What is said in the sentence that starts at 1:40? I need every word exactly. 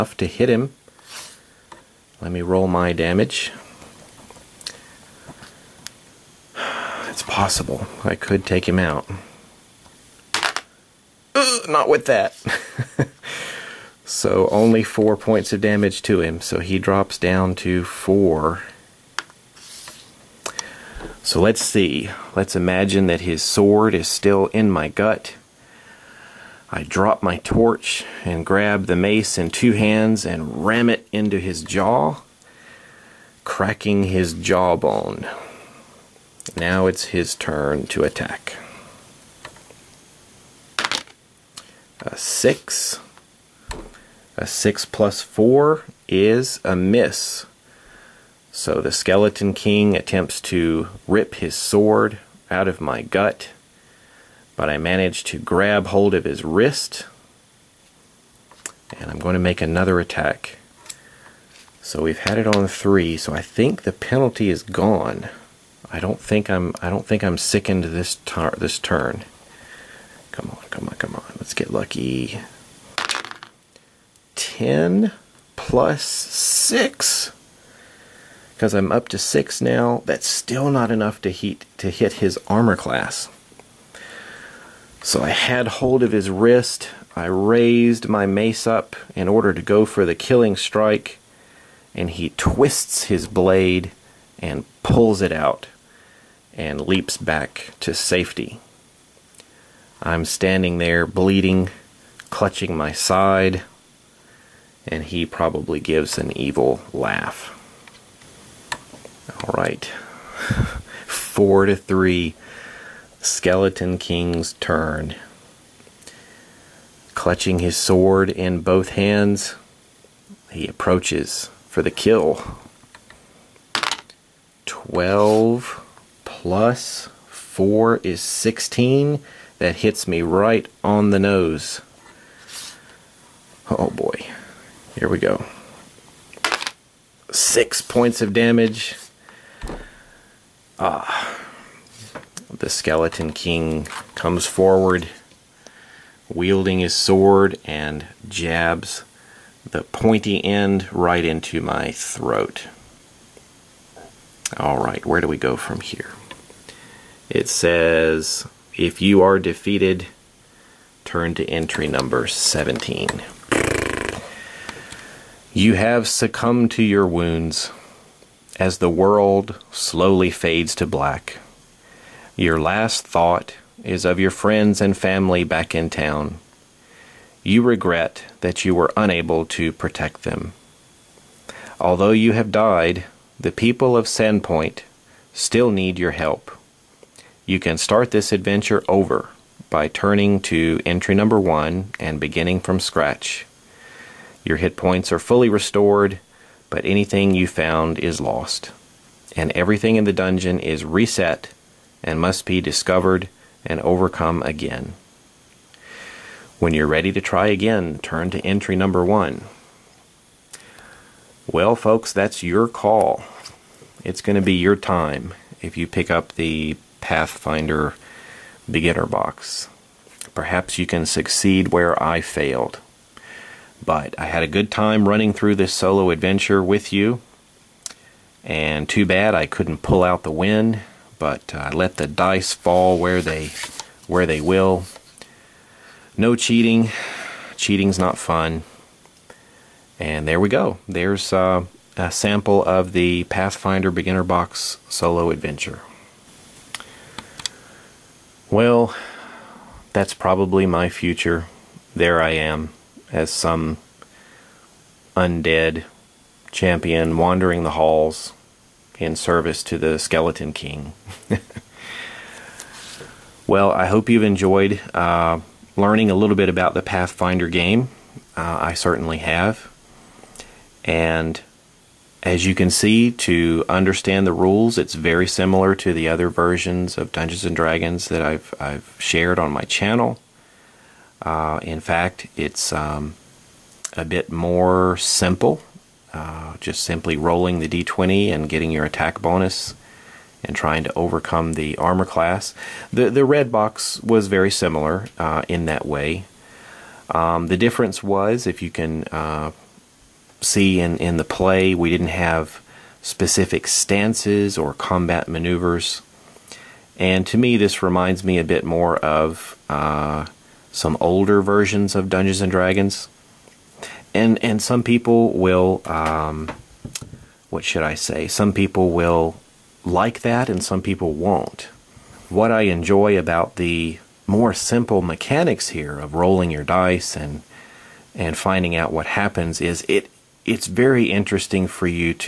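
I'm standing there bleeding, clutching my side, and he probably gives an evil laugh.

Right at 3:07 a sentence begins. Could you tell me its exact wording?
You can start this adventure over by turning to entry number one and beginning from scratch.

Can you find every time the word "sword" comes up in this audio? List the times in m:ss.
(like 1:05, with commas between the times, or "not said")
0:23, 0:51, 1:57, 2:26.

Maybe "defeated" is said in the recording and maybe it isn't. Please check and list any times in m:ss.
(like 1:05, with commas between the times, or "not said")
2:39.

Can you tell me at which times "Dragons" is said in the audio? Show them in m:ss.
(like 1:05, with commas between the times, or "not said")
4:37, 5:12.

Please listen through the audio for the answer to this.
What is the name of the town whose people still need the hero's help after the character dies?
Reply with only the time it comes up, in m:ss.
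3:04.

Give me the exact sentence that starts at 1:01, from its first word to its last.
So we've had it on three, so I think the penalty is gone.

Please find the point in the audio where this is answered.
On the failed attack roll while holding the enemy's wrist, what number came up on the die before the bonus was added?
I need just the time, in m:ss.
1:14.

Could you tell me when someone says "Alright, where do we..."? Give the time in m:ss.
2:34.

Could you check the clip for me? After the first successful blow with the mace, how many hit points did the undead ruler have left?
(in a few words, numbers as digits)
4.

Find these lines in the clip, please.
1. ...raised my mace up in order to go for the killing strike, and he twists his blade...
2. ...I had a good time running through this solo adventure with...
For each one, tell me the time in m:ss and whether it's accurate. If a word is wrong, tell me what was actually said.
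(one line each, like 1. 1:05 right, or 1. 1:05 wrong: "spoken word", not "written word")
1. 1:27 right
2. 3:44 right.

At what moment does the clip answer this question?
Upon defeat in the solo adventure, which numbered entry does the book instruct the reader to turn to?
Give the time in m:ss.
2:41.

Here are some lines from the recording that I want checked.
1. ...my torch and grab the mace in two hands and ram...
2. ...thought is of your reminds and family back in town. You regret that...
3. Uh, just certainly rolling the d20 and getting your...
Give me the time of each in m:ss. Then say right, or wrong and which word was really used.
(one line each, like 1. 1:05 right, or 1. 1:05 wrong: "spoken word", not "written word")
1. 0:27 right
2. 2:53 wrong: "friends", not "reminds"
3. 4:46 wrong: "simply", not "certainly".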